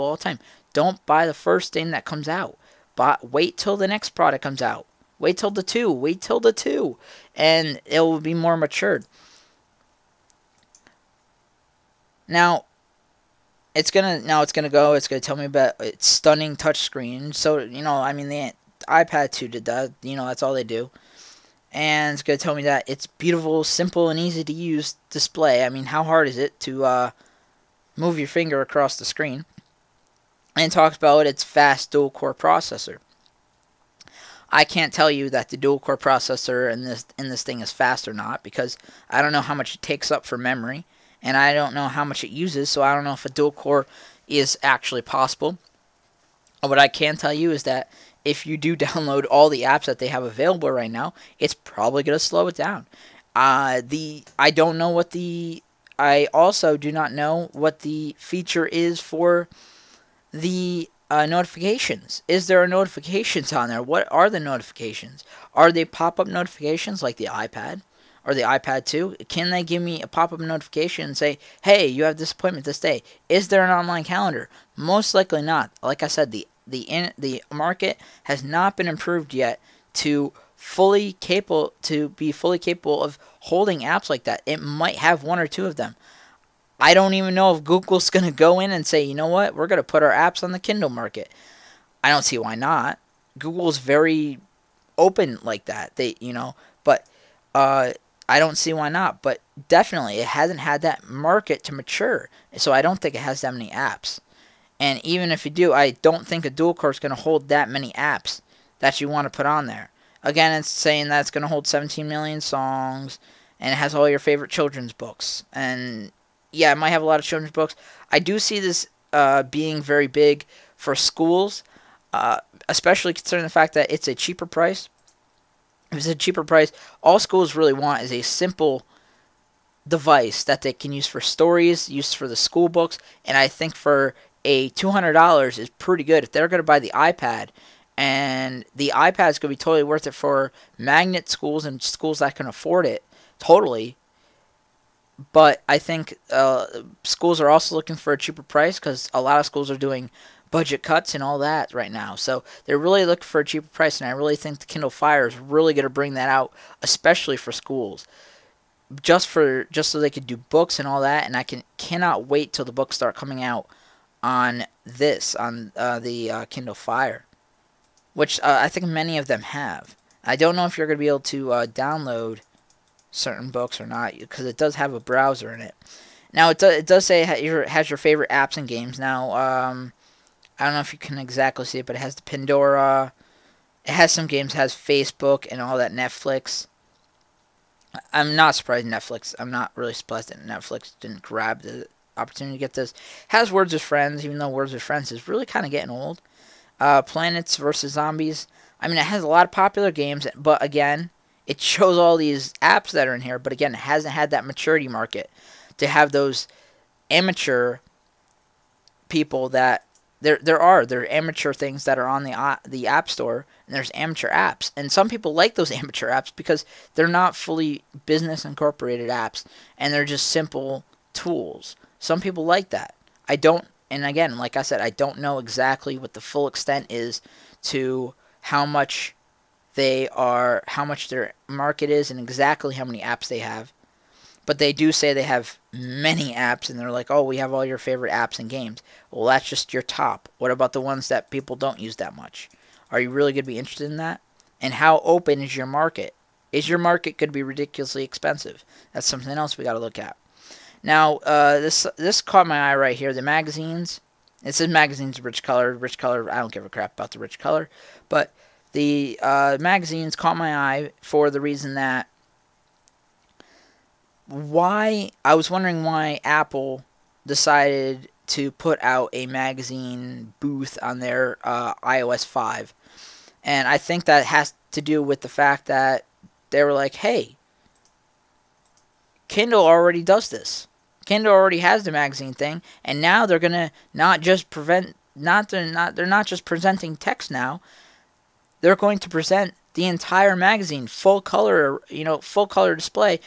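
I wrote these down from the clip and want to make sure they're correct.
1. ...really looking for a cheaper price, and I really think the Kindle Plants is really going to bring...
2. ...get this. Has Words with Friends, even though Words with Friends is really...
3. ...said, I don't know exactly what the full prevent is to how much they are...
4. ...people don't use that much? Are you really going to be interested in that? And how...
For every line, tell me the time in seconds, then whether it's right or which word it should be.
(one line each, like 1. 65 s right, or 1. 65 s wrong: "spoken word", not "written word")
1. 152 s wrong: "Fire", not "Plants"
2. 192 s right
3. 224 s wrong: "extent", not "prevent"
4. 241 s right.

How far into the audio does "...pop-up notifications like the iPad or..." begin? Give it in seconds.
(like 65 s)
65 s.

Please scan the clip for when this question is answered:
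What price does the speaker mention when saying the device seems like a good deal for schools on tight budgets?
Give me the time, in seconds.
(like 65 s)
134 s.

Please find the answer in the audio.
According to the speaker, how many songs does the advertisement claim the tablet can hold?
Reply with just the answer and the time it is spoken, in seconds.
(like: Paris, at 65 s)
17 million, at 111 s.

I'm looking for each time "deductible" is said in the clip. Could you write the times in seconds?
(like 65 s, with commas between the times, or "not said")
not said.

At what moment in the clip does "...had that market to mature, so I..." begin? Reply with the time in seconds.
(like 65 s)
100 s.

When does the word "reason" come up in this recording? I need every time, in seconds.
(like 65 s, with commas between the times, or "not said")
261 s.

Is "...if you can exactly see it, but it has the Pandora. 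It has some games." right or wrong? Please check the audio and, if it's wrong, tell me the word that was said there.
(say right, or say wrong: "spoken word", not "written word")
right.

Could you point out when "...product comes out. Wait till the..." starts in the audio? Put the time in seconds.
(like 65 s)
4 s.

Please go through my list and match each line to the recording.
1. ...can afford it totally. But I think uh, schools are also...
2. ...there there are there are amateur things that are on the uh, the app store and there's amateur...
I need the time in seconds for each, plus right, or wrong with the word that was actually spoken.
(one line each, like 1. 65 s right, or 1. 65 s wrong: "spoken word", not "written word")
1. 142 s right
2. 210 s right.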